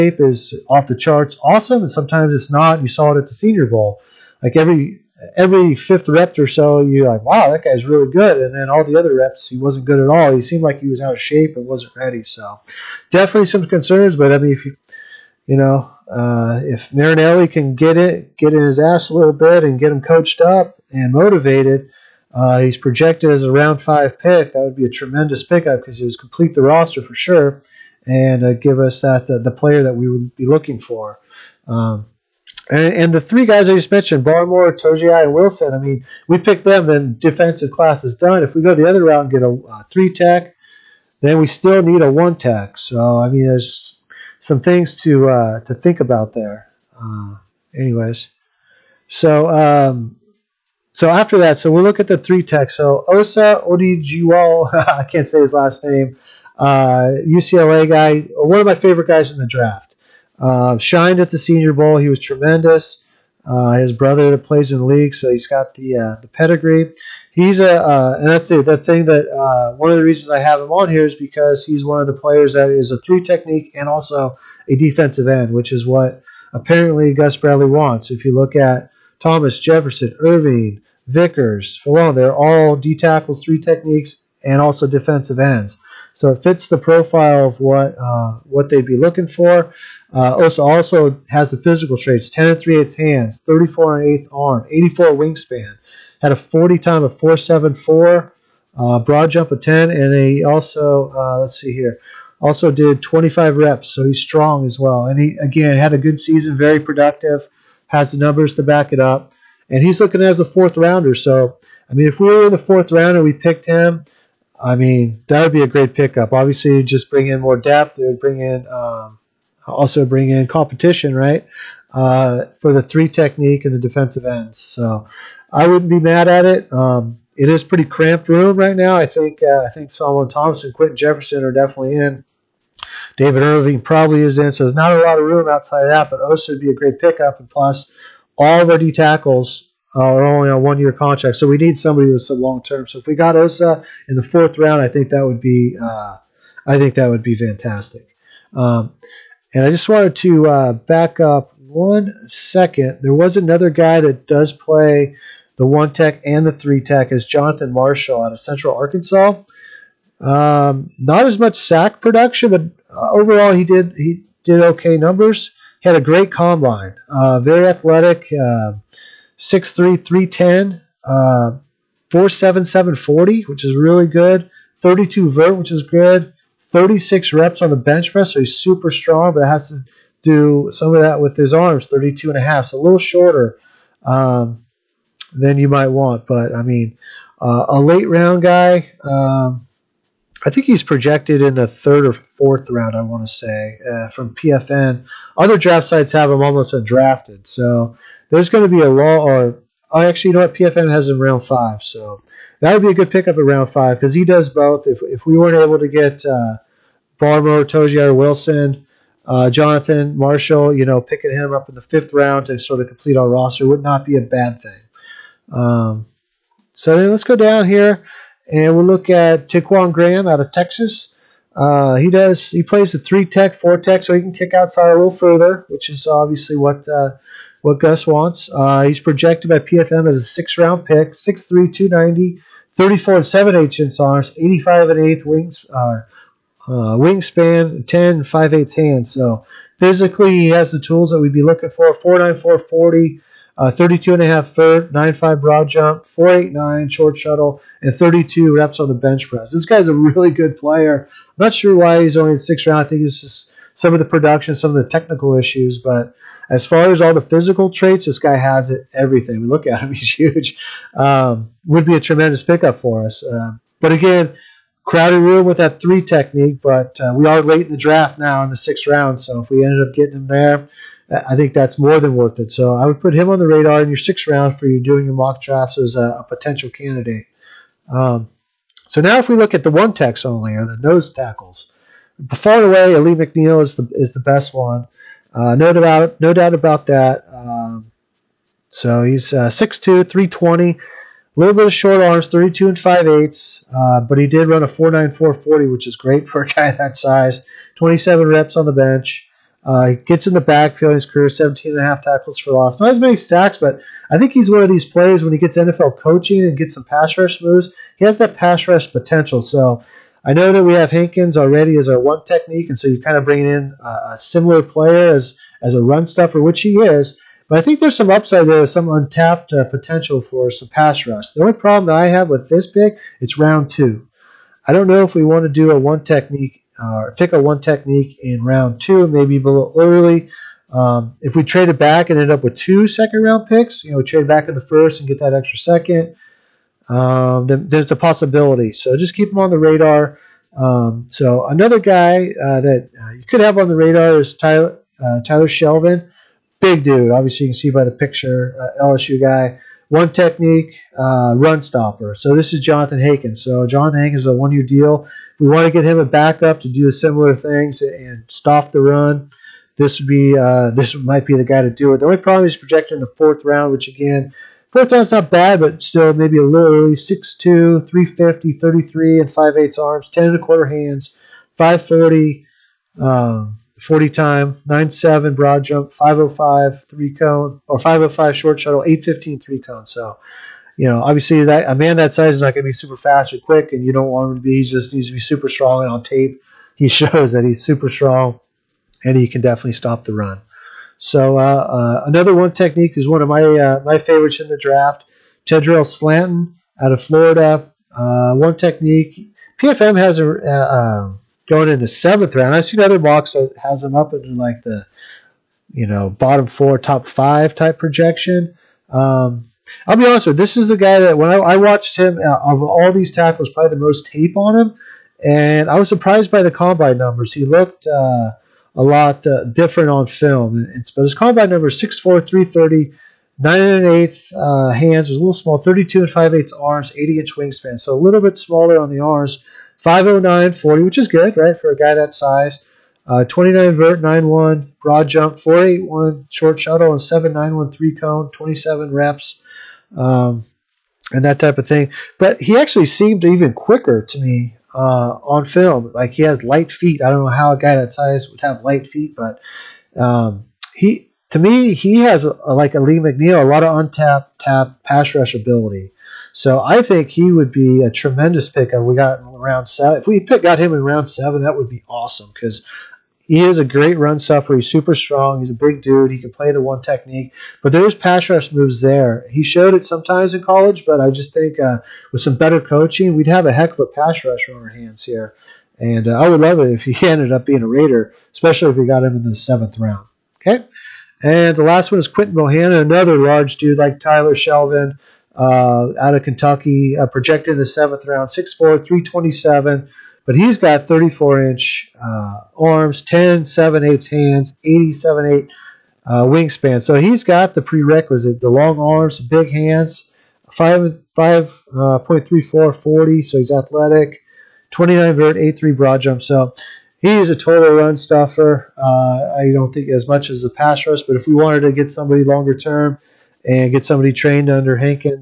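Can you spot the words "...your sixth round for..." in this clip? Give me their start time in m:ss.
4:33.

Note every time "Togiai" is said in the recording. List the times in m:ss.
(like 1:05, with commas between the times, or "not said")
0:34, 3:27.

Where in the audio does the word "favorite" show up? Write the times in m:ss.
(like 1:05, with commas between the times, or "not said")
0:58, 6:33.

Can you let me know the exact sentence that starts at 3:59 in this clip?
So physically, he has the tools that we'd be looking for.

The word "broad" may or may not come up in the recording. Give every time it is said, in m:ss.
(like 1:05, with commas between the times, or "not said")
1:38, 4:05, 6:15, 7:14, 8:25.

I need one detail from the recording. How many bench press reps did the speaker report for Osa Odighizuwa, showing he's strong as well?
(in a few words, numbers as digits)
25.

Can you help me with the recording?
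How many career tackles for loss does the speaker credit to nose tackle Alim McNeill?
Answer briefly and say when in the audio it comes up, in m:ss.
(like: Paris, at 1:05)
17.5, at 5:01.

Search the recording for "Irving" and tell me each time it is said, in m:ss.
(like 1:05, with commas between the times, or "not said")
1:20, 2:13.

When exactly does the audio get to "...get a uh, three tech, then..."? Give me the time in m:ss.
0:39.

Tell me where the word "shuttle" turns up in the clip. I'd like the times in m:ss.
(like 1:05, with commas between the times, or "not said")
4:07, 6:18, 7:16.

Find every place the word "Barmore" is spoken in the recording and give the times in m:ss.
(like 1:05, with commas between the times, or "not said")
0:34, 3:27.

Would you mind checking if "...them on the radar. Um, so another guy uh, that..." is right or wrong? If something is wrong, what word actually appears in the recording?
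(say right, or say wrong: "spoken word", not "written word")
right.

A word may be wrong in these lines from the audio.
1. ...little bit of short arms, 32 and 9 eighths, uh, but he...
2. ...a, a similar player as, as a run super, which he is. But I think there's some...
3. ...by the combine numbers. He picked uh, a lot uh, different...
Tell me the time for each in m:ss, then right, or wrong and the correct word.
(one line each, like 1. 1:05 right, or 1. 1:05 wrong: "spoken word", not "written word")
1. 4:51 wrong: "5", not "9"
2. 5:13 wrong: "stuffer", not "super"
3. 6:56 wrong: "looked", not "picked".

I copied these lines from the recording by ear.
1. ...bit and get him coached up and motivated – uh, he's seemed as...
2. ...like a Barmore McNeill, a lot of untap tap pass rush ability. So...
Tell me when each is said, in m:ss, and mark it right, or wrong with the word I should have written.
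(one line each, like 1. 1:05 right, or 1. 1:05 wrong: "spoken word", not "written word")
1. 0:19 wrong: "projected", not "seemed"
2. 7:32 wrong: "Lee", not "Barmore".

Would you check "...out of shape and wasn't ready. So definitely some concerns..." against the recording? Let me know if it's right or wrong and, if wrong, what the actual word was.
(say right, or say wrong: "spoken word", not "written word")
right.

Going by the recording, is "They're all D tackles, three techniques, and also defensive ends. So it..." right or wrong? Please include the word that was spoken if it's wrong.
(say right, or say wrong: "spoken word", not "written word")
right.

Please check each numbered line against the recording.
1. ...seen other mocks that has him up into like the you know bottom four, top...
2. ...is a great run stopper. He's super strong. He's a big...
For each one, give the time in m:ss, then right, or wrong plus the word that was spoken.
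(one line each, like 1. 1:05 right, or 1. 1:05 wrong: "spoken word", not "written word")
1. 6:42 right
2. 7:43 right.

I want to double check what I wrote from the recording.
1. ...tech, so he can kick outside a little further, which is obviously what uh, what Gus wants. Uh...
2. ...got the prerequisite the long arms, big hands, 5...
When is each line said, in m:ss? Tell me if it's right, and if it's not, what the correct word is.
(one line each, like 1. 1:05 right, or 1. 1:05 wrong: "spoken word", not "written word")
1. 3:43 right
2. 8:17 right.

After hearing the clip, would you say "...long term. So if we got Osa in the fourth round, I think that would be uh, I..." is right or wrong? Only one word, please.
right.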